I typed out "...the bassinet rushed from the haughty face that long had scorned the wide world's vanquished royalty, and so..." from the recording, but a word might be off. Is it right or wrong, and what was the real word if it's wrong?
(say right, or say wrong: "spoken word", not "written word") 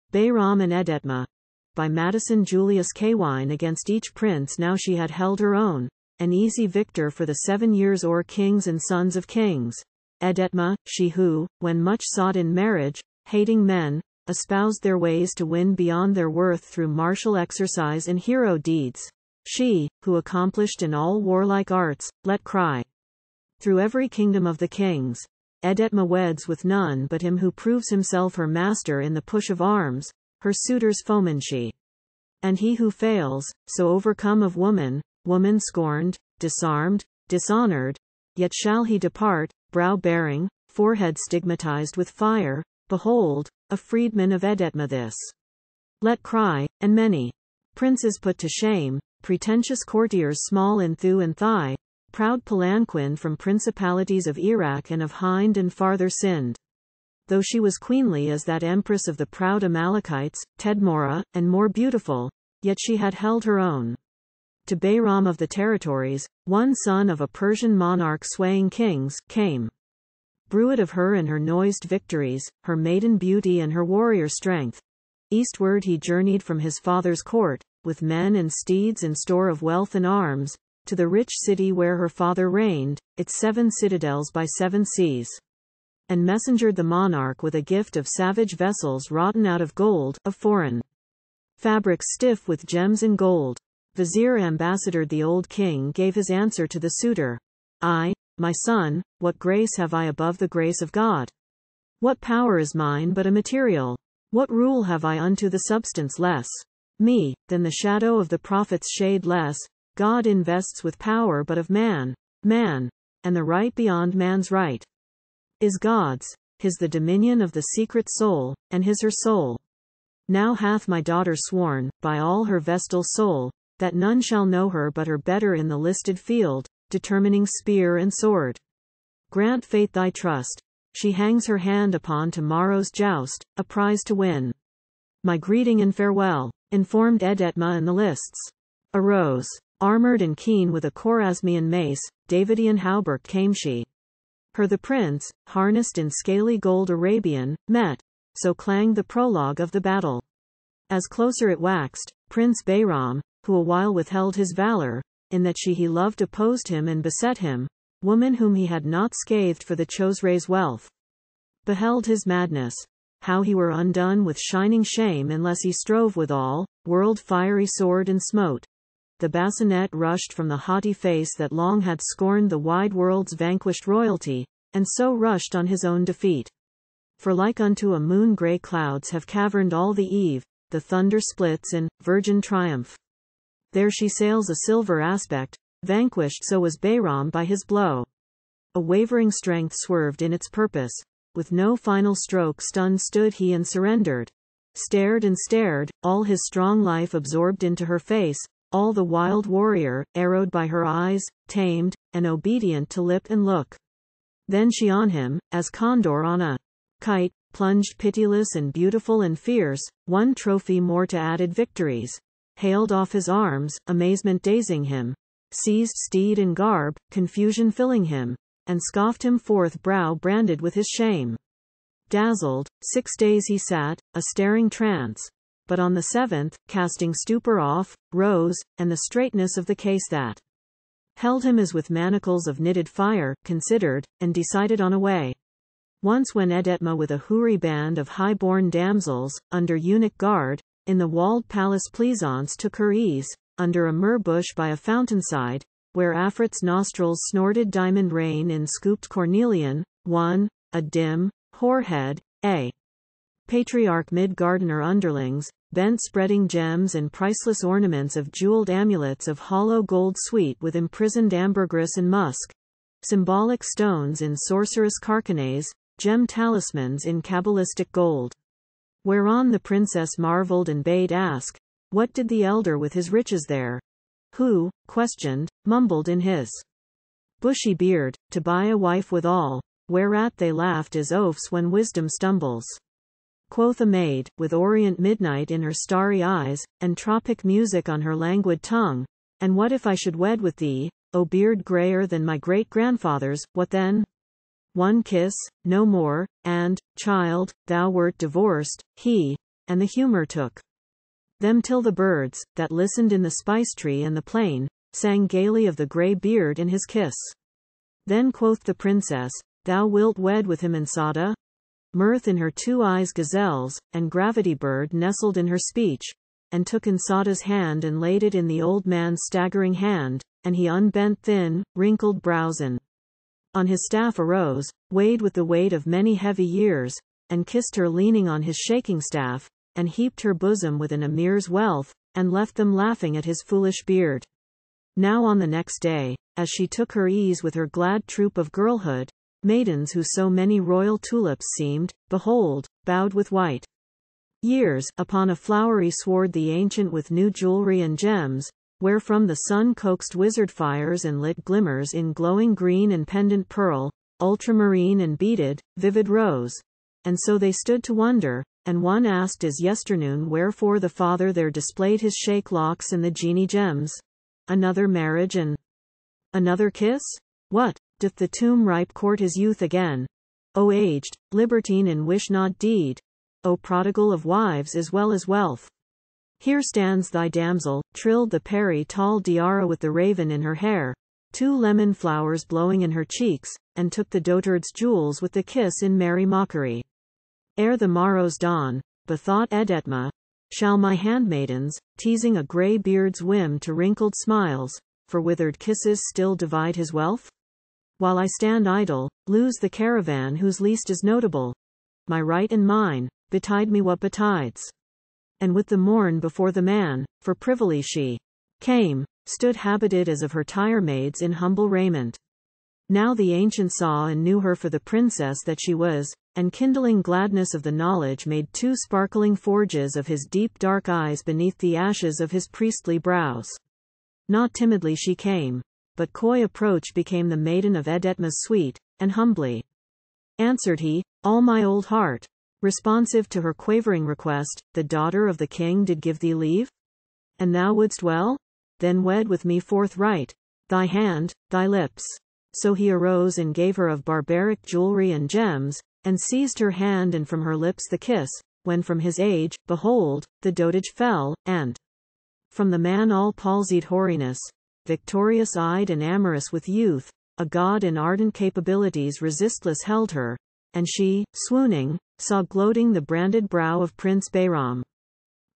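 right.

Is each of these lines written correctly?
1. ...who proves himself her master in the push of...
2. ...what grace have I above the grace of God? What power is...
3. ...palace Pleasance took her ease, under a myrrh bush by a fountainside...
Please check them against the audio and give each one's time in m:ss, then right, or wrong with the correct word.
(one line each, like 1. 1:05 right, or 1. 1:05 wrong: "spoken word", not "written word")
1. 0:27 right
2. 1:39 right
3. 4:01 right.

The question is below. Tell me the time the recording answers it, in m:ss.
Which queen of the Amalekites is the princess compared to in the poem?
1:00.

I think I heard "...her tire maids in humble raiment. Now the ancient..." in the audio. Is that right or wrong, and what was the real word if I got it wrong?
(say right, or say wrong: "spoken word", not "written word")
right.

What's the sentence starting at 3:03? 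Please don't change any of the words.
There she sails a silver aspect, vanquished so was Behram by his blow.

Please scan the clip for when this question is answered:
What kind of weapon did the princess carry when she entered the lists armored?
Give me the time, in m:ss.
2:20.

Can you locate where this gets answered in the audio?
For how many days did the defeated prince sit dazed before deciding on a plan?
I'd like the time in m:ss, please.
3:42.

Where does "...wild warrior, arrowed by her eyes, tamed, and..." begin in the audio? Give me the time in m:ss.
3:19.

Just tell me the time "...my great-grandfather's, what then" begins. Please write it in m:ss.
4:52.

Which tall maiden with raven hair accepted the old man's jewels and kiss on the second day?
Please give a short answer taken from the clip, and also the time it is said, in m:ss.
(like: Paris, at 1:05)
Diara, at 6:19.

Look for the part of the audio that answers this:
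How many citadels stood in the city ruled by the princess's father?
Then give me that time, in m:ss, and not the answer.
1:23.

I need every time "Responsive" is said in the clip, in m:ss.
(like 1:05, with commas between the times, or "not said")
7:12.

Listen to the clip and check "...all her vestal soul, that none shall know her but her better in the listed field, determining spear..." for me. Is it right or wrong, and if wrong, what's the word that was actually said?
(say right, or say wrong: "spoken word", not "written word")
right.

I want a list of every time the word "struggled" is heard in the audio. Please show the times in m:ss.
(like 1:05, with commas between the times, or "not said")
not said.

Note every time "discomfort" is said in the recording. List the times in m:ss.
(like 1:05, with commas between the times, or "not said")
not said.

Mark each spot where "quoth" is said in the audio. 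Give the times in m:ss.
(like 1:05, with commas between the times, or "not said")
4:43, 5:08.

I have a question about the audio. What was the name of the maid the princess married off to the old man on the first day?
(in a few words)
Insada.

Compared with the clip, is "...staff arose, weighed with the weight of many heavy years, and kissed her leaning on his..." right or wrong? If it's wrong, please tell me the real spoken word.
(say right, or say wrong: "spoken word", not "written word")
right.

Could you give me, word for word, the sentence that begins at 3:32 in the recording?
Hailed off his arms, amazement dazing him.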